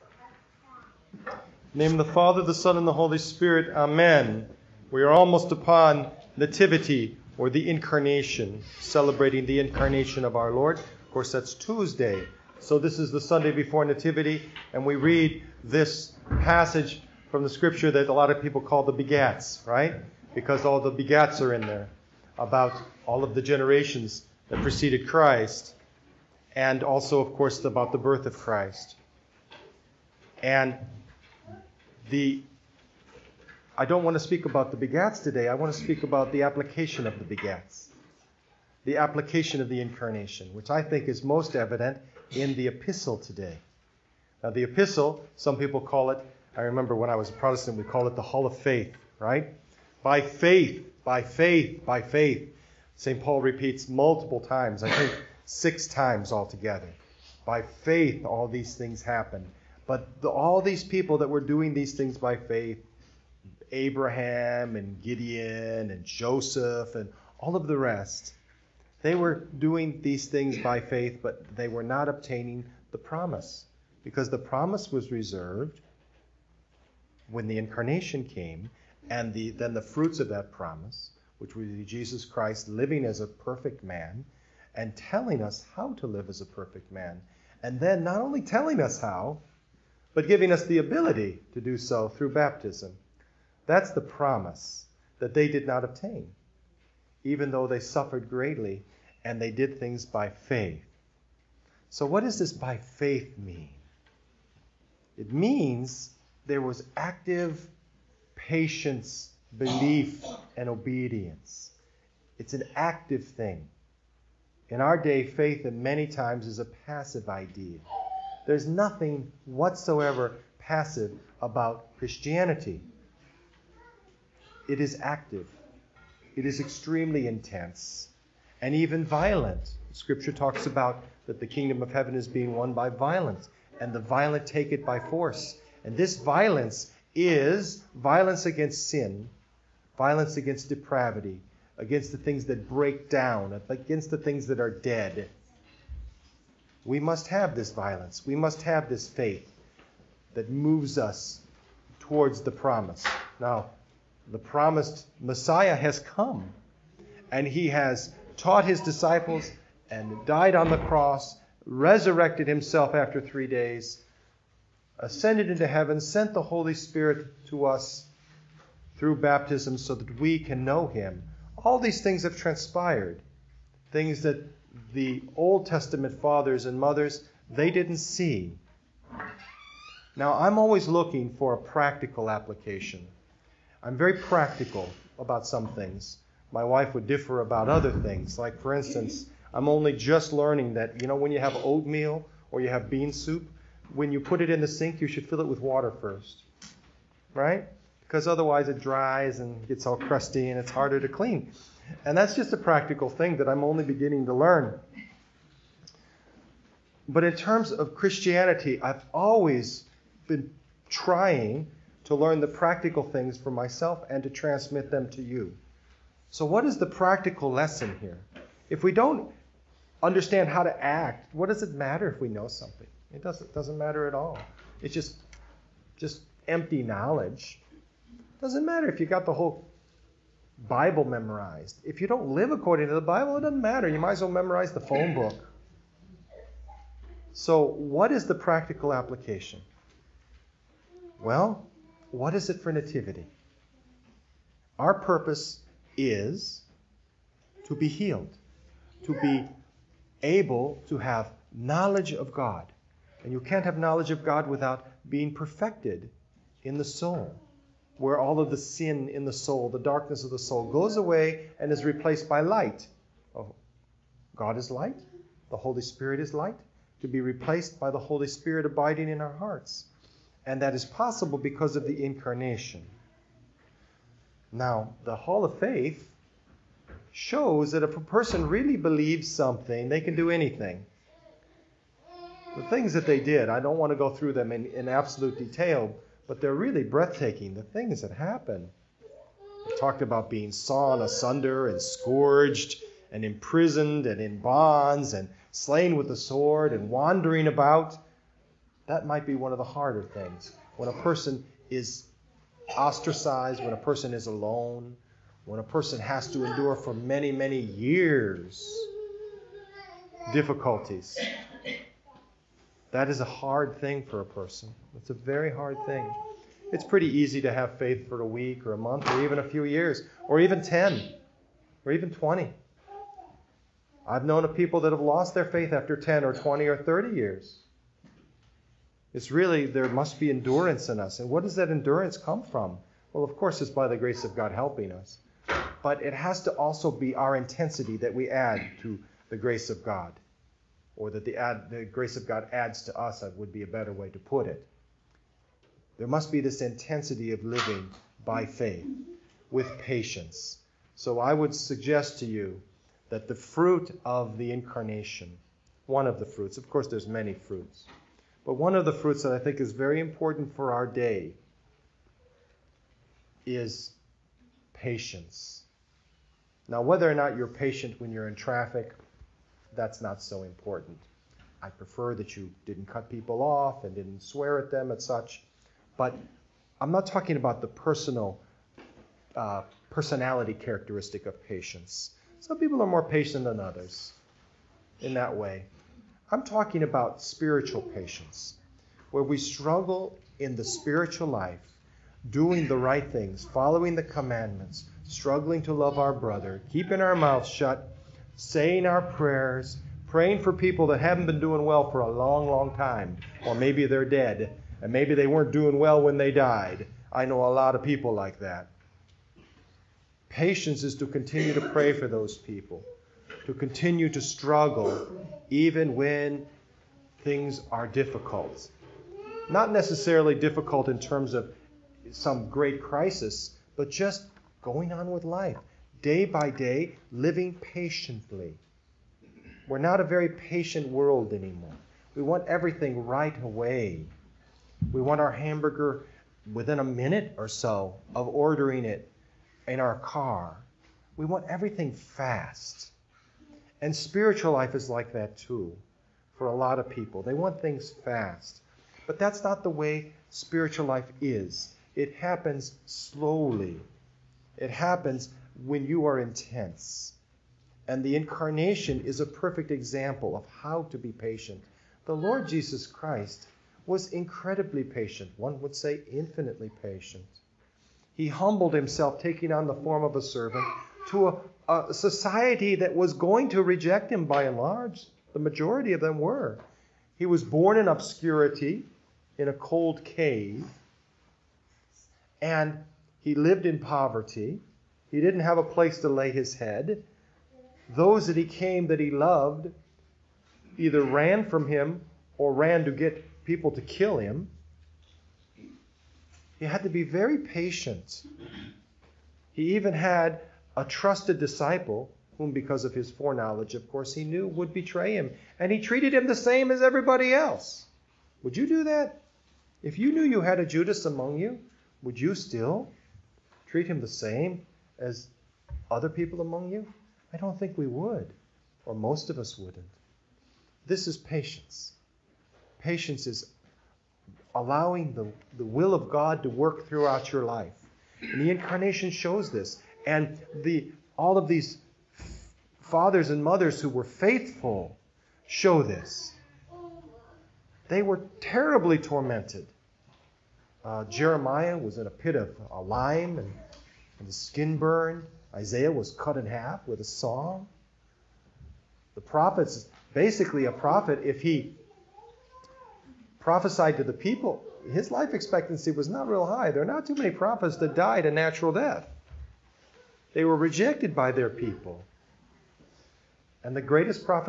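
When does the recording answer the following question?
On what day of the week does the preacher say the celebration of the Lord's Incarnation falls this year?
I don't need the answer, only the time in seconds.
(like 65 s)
11 s.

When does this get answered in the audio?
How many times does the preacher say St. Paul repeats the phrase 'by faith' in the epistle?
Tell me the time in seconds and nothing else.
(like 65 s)
55 s.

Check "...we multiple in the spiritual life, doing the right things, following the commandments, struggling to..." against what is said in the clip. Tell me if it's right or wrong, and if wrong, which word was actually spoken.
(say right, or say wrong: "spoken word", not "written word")
wrong: "struggle", not "multiple".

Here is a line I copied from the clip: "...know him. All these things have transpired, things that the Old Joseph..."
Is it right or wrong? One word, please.
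wrong.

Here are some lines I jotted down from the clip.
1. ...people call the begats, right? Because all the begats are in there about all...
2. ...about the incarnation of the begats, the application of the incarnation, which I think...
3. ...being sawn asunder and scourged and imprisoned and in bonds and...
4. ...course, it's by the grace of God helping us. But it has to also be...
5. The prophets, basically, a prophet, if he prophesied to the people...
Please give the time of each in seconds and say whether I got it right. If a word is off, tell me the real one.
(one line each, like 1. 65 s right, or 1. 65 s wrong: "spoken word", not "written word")
1. 18 s right
2. 36 s wrong: "application", not "incarnation"
3. 290 s right
4. 333 s right
5. 549 s right.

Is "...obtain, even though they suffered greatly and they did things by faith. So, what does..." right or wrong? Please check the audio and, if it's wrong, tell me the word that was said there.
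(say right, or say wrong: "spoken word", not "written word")
right.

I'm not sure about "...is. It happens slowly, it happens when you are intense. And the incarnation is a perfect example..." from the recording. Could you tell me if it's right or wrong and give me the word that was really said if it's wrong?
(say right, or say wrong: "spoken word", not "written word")
right.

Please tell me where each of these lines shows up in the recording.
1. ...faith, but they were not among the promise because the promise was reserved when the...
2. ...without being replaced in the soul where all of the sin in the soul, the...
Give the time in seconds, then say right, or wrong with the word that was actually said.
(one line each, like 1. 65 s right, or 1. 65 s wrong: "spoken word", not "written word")
1. 70 s wrong: "obtaining", not "among"
2. 254 s wrong: "perfected", not "replaced".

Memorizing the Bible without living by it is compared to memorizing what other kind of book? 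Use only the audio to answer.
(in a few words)
phone book.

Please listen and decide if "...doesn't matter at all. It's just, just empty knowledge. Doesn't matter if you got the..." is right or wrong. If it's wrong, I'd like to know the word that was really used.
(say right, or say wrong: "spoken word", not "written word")
right.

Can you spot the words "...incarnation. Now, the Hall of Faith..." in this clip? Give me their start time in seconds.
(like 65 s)
272 s.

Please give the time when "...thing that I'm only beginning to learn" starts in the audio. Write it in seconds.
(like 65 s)
203 s.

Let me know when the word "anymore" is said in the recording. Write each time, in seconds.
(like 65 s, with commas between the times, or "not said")
431 s.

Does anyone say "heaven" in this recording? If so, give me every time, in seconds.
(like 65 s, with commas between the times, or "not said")
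131 s, 165 s.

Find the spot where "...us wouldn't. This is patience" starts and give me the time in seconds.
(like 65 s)
519 s.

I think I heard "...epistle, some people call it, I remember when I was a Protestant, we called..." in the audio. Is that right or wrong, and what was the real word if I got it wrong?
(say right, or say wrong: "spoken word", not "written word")
right.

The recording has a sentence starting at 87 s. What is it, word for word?
And then not only telling us how, but giving us the ability to do so through baptism.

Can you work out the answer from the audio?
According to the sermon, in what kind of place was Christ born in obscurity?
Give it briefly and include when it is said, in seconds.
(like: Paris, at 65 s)
a cold cave, at 479 s.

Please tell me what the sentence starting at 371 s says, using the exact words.
I prefer that you didn't cut people off and didn't swear at them and such.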